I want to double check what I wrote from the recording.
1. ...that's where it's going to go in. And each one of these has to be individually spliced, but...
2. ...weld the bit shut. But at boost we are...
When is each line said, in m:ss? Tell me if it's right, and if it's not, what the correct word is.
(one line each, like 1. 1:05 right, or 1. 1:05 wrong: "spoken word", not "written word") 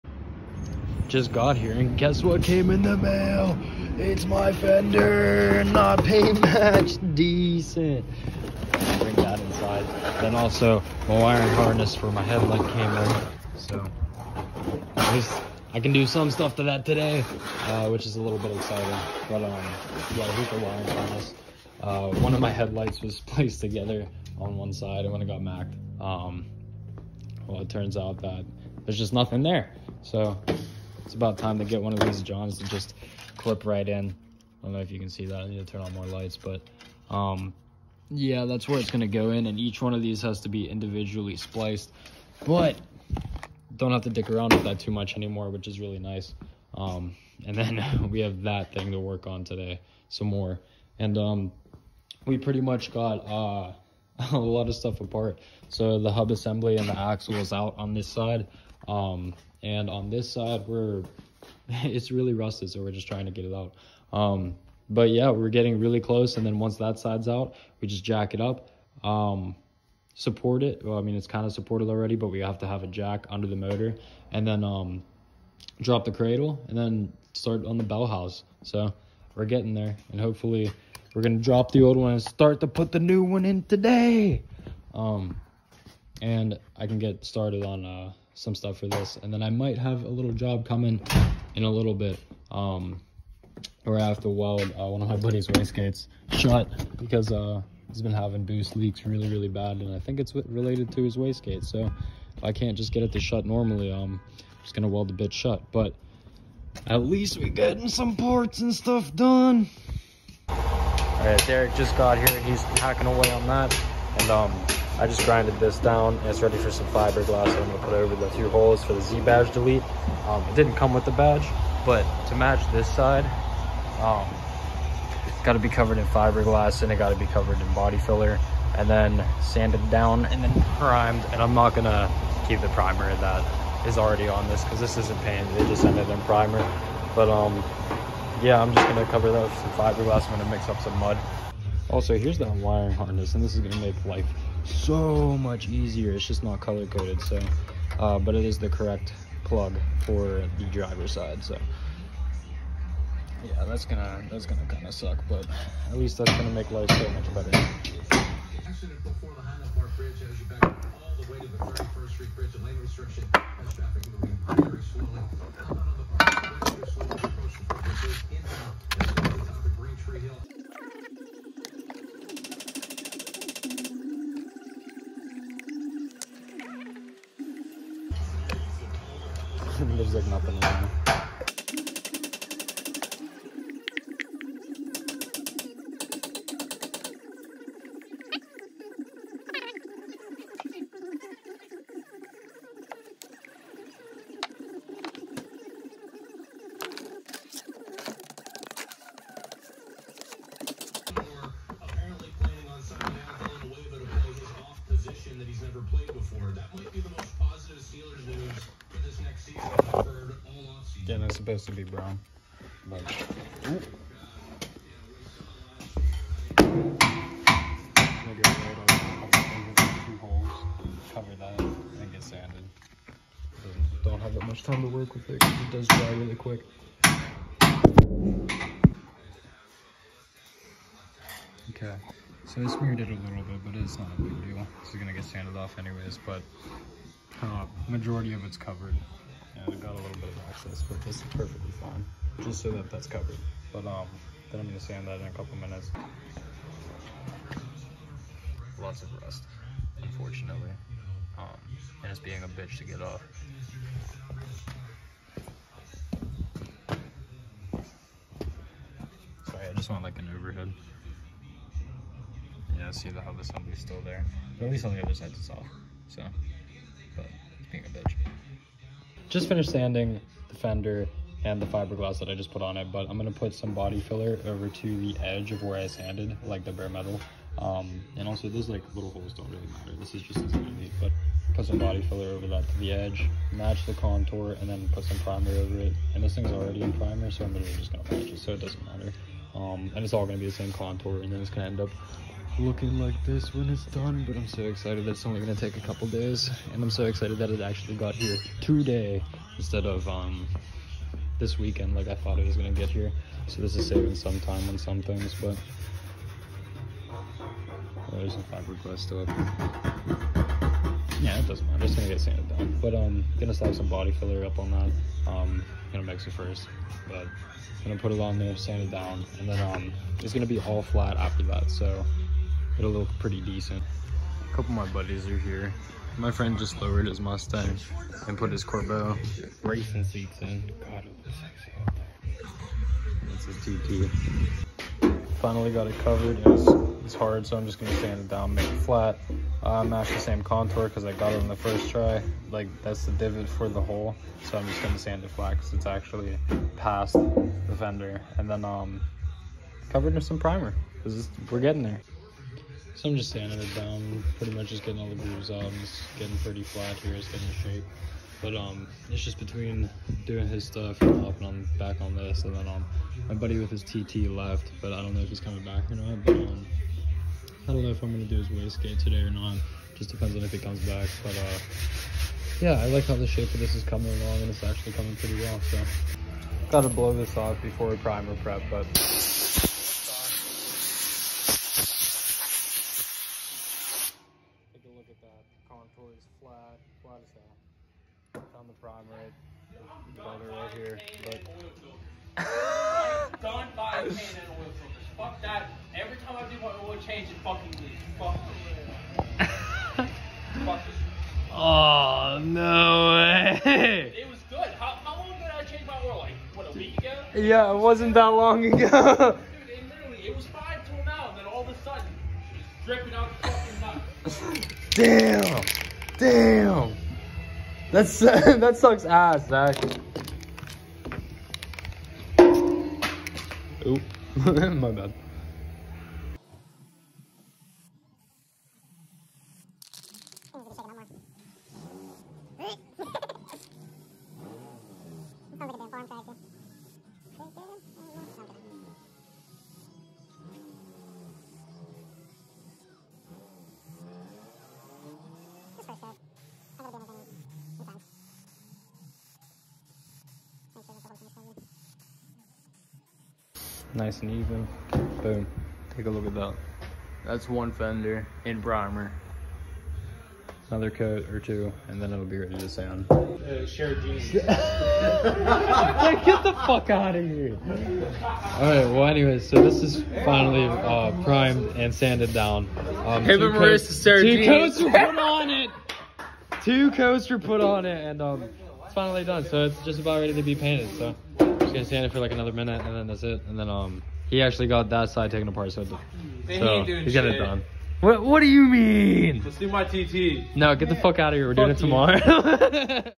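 1. 0:38 right
2. 1:44 wrong: "least", not "boost".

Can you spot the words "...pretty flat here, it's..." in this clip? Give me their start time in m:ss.
5:56.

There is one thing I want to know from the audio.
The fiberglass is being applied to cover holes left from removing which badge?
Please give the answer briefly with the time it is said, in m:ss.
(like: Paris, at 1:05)
Z badge, at 1:59.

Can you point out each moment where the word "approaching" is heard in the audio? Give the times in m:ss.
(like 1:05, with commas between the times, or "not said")
2:47.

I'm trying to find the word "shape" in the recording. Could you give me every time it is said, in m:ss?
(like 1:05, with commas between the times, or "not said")
5:57, 6:13.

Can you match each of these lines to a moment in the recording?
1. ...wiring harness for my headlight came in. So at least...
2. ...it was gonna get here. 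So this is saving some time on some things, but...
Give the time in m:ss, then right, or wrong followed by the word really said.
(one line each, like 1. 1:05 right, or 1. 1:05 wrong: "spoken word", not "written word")
1. 0:11 right
2. 5:02 right.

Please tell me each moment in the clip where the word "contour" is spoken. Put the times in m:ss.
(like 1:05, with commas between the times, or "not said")
4:43, 4:50, 5:40, 6:25.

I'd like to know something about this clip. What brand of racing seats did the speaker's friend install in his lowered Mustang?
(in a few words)
Corbeau.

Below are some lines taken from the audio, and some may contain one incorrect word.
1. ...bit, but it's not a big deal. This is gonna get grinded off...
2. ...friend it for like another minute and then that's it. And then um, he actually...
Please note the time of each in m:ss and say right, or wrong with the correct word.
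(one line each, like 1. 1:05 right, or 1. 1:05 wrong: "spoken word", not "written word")
1. 3:53 wrong: "sanded", not "grinded"
2. 8:01 wrong: "stand", not "friend".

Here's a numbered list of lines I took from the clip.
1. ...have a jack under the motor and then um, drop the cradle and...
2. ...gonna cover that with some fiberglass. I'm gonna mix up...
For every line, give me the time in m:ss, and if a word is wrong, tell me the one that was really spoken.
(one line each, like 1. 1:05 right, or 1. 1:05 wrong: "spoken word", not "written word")
1. 1:12 right
2. 2:18 right.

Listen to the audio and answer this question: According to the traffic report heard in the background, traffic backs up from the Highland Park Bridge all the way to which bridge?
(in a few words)
31st Street Bridge.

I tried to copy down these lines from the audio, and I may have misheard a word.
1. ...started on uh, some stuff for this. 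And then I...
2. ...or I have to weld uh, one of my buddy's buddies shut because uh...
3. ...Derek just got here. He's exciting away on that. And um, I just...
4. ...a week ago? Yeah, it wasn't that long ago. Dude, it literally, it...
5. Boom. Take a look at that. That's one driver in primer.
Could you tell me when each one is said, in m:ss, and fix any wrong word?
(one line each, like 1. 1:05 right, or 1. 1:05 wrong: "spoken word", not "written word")
1. 1:27 right
2. 1:33 wrong: "wastegates", not "buddies"
3. 1:51 wrong: "hacking", not "exciting"
4. 6:46 right
5. 7:35 wrong: "fender", not "driver".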